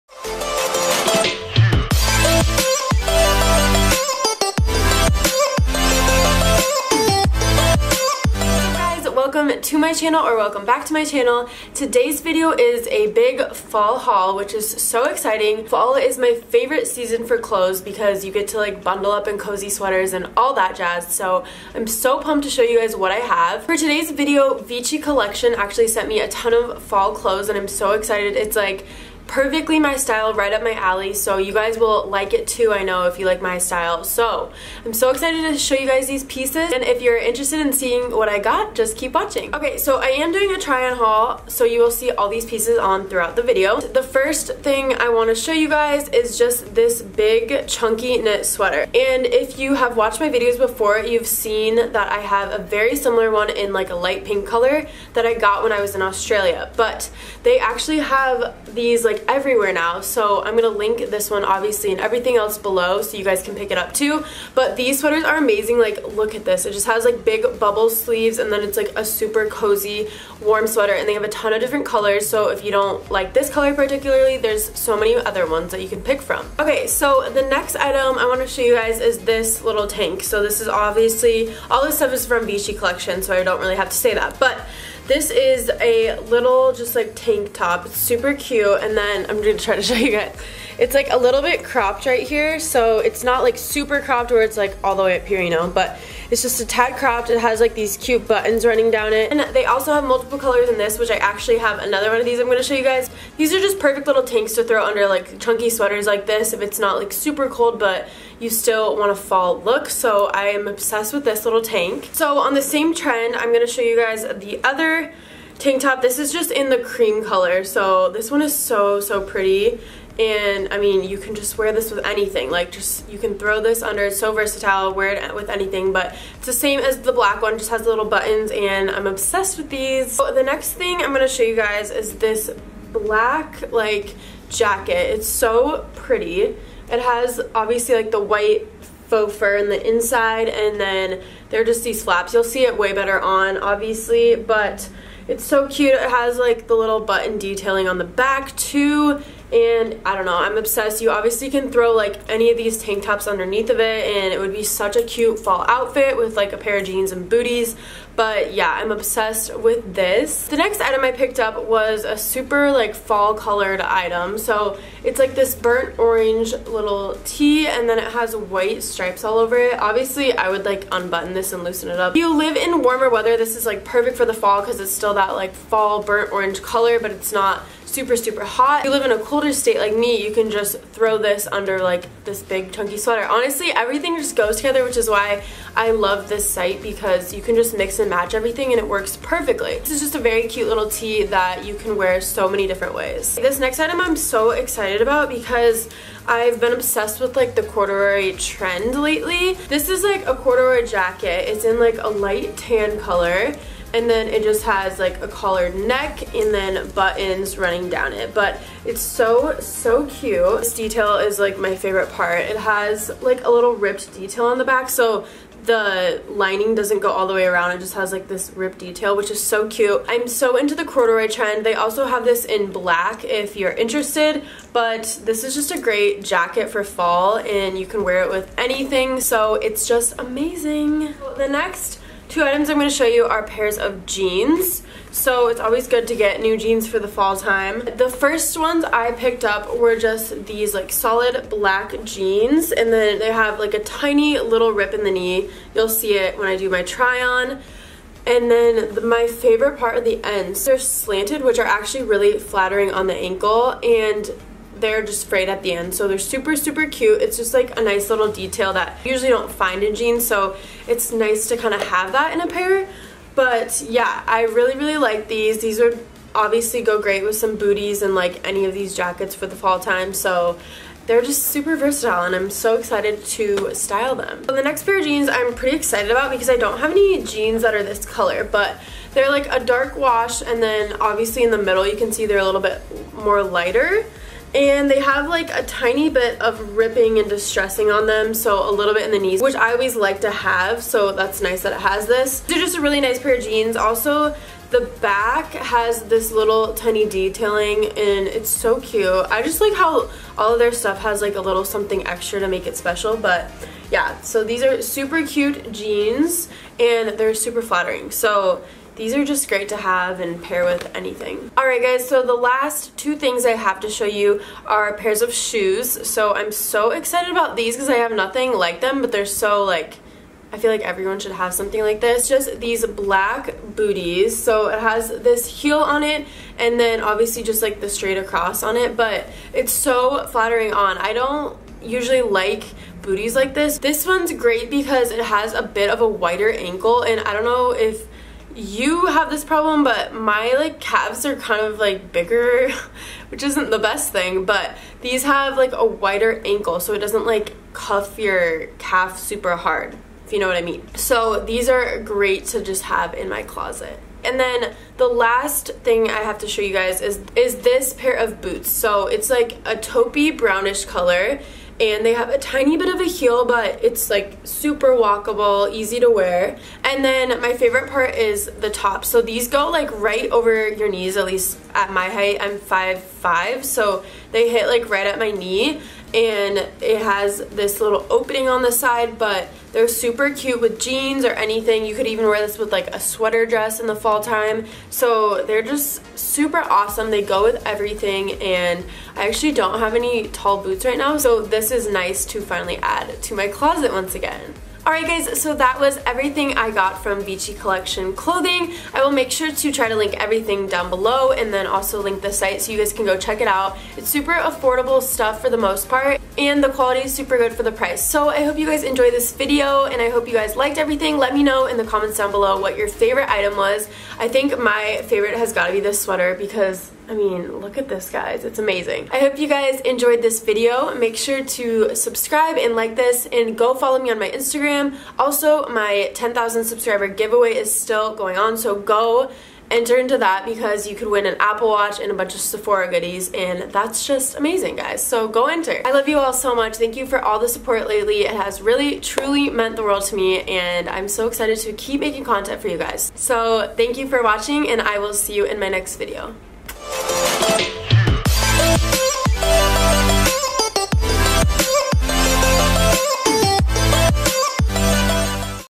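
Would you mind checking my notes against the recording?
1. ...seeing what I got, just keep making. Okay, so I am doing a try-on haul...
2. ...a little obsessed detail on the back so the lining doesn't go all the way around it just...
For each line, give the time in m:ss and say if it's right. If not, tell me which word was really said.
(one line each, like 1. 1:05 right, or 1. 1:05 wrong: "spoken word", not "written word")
1. 0:37 wrong: "watching", not "making"
2. 3:33 wrong: "ripped", not "obsessed".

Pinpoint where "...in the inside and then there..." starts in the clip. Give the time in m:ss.
2:19.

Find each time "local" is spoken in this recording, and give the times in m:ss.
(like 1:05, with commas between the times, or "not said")
not said.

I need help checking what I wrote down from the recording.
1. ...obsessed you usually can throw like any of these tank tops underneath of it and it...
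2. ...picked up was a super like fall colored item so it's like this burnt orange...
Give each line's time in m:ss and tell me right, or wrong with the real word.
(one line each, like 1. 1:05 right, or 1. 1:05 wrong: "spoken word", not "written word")
1. 2:30 wrong: "obviously", not "usually"
2. 2:41 right.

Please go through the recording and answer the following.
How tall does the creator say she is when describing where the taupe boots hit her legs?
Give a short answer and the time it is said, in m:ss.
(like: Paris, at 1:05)
5'5, at 6:12.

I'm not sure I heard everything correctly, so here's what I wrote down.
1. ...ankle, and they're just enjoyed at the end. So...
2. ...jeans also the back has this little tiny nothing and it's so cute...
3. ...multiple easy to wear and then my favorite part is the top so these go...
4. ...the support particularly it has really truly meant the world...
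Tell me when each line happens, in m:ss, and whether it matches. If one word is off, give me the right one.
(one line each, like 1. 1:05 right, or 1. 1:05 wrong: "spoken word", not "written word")
1. 4:13 wrong: "frayed", not "enjoyed"
2. 4:53 wrong: "detailing", not "nothing"
3. 6:04 wrong: "walkable", not "multiple"
4. 7:17 wrong: "lately", not "particularly".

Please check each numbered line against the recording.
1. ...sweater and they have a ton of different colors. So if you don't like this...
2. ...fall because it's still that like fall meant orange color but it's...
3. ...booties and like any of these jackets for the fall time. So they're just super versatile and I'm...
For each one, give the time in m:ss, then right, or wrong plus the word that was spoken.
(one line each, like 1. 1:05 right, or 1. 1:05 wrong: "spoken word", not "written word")
1. 1:10 right
2. 2:54 wrong: "burnt", not "meant"
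3. 4:27 right.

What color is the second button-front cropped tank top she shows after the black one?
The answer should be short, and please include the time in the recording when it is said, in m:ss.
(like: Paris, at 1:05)
cream, at 1:56.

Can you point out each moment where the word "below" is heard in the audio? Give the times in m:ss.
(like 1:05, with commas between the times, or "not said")
1:02, 6:40, 6:52.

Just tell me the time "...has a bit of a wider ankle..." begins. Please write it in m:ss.
5:35.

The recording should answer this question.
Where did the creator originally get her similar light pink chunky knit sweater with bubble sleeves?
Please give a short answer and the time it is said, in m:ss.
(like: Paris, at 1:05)
Australia, at 0:56.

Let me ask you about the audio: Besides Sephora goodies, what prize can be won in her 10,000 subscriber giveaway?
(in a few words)
Apple Watch.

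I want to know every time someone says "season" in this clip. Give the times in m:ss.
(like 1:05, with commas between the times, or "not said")
0:16.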